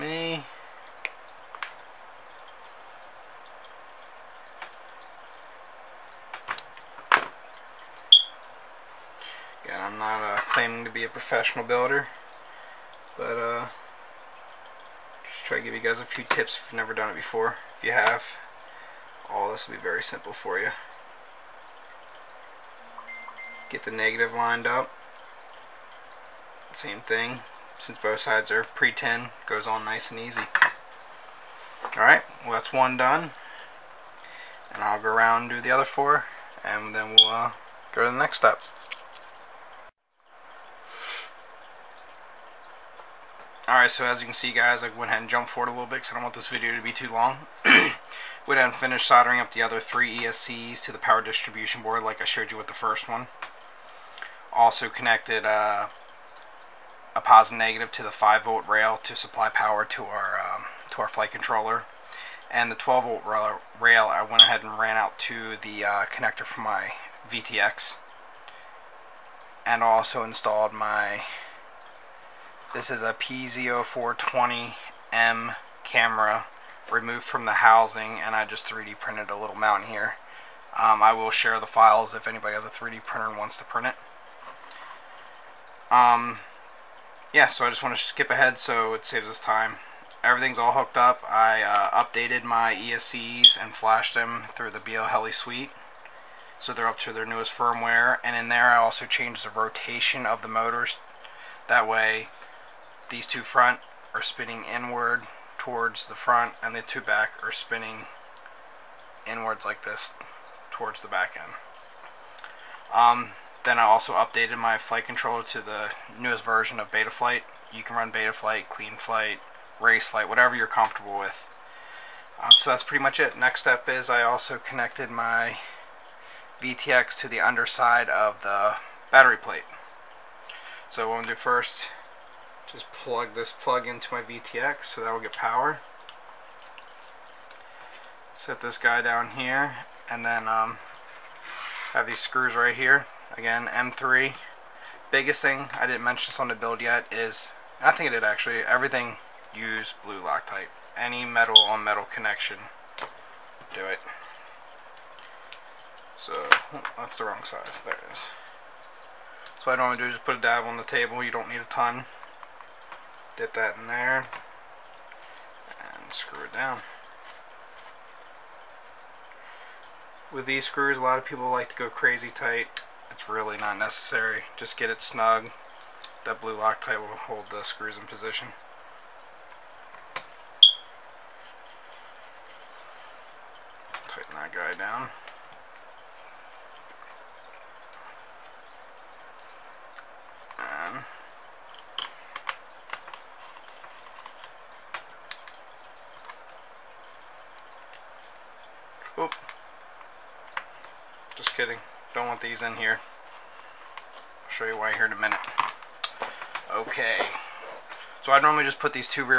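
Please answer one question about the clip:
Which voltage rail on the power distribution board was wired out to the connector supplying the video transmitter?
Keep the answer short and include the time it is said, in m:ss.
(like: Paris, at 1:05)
12 volt, at 1:02.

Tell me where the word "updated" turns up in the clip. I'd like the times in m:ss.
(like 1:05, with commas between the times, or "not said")
1:32, 1:54.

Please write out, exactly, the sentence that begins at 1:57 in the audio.
You can run Betaflight, Cleanflight, Race Flight, whatever you're comfortable with.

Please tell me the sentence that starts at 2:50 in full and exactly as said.
With these screws, a lot of people like to go crazy tight.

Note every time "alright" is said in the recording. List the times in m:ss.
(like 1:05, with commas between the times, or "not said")
0:31, 0:43.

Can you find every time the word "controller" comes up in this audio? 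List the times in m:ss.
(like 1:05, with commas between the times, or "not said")
1:01, 1:55.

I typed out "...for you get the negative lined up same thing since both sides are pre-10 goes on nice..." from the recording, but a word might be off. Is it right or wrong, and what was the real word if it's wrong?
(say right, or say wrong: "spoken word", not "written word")
right.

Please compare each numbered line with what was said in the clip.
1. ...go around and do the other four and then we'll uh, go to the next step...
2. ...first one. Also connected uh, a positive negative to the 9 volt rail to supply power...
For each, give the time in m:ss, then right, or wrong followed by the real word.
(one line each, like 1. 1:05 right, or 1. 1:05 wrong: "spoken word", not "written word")
1. 0:35 right
2. 0:52 wrong: "5", not "9".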